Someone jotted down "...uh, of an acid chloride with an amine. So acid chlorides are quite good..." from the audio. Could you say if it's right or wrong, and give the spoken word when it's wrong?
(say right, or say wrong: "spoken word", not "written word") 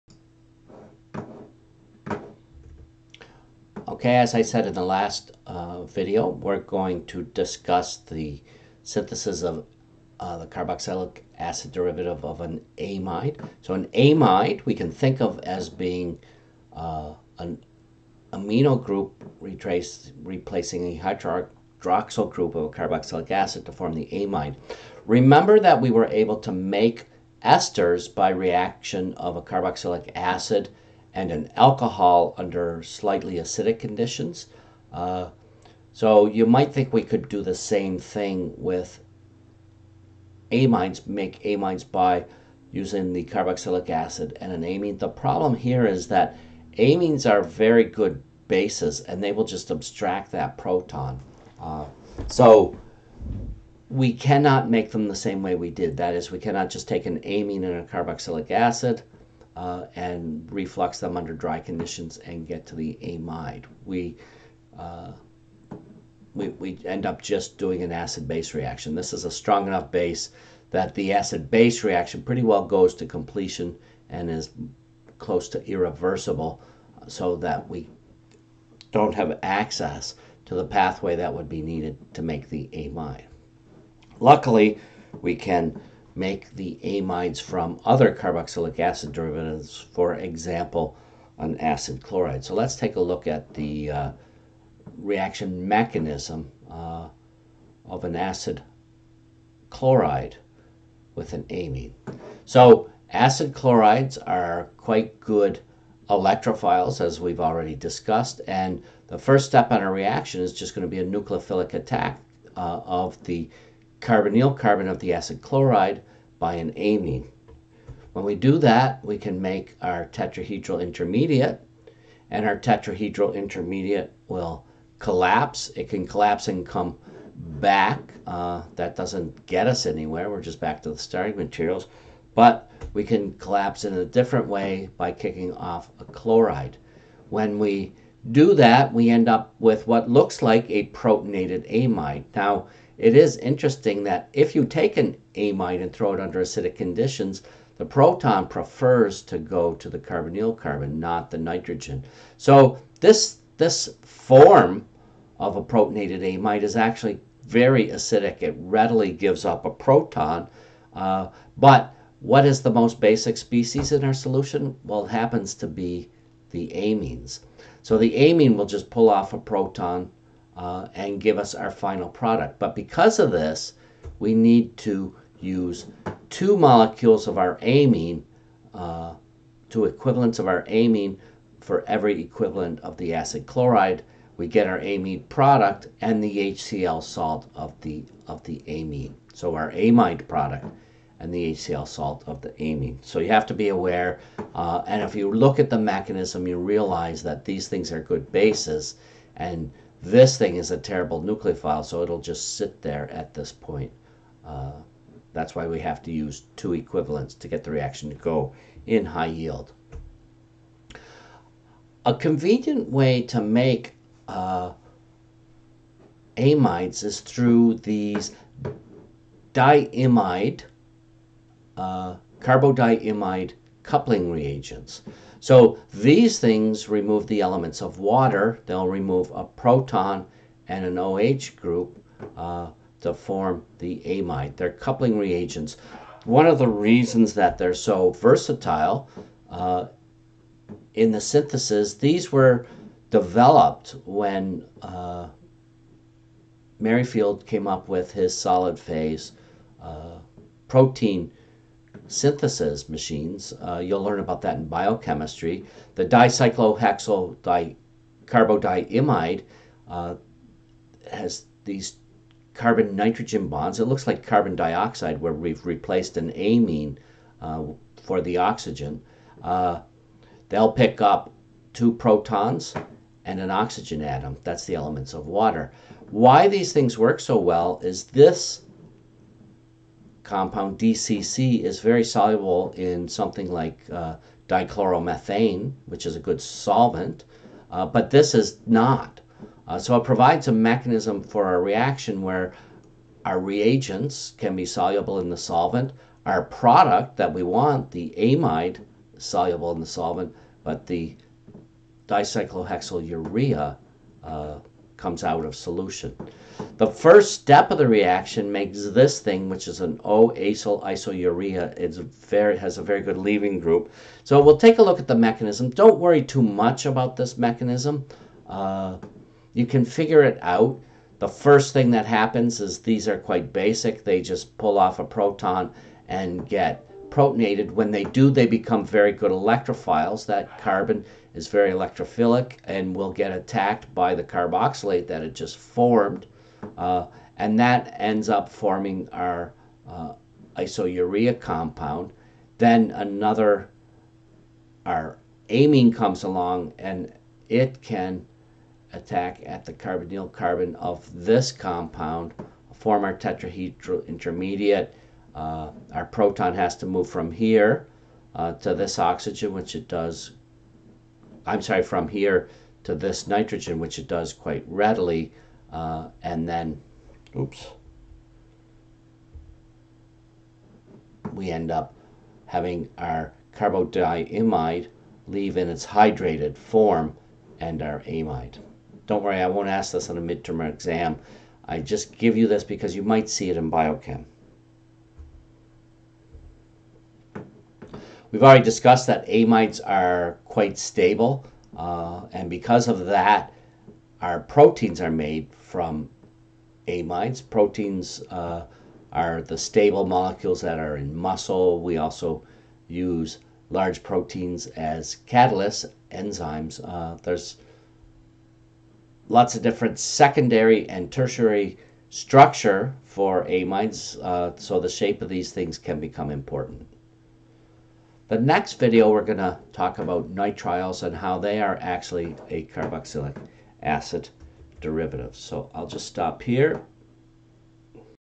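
right.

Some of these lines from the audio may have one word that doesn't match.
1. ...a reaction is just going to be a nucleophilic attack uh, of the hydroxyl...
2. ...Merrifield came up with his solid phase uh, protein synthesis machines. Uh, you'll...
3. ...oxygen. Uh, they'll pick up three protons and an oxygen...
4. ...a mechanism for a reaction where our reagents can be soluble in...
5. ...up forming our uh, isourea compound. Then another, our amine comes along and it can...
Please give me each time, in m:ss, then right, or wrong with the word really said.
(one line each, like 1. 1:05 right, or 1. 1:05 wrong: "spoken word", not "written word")
1. 1:49 wrong: "carbonyl", not "hydroxyl"
2. 4:06 right
3. 4:28 wrong: "two", not "three"
4. 4:50 right
5. 5:38 right.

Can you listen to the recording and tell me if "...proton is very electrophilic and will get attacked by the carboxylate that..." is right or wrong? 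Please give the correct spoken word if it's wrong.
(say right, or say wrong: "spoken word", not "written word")
wrong: "carbon", not "proton".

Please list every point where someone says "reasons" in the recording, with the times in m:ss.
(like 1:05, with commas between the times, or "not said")
3:56.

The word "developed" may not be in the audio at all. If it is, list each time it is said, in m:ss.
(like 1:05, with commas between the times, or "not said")
4:03.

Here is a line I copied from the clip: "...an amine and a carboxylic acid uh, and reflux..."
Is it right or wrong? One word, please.
right.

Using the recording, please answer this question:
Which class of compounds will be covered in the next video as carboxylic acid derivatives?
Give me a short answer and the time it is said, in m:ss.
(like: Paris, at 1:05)
nitriles, at 7:00.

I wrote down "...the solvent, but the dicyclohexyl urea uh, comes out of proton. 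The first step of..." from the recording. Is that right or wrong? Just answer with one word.
wrong.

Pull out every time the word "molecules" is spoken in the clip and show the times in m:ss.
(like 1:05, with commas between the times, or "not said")
2:56, 6:40.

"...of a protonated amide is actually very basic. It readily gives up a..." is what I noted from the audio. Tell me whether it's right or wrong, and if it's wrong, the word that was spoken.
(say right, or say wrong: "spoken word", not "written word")
wrong: "acidic", not "basic".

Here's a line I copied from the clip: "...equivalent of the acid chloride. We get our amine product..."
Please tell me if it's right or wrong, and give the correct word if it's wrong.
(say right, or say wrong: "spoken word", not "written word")
right.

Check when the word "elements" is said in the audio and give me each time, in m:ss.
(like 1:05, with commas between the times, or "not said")
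3:47, 4:34.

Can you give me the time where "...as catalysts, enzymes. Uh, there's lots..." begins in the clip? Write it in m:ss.
6:44.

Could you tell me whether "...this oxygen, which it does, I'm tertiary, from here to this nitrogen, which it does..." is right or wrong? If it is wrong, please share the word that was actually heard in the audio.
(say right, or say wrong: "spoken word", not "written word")
wrong: "sorry", not "tertiary".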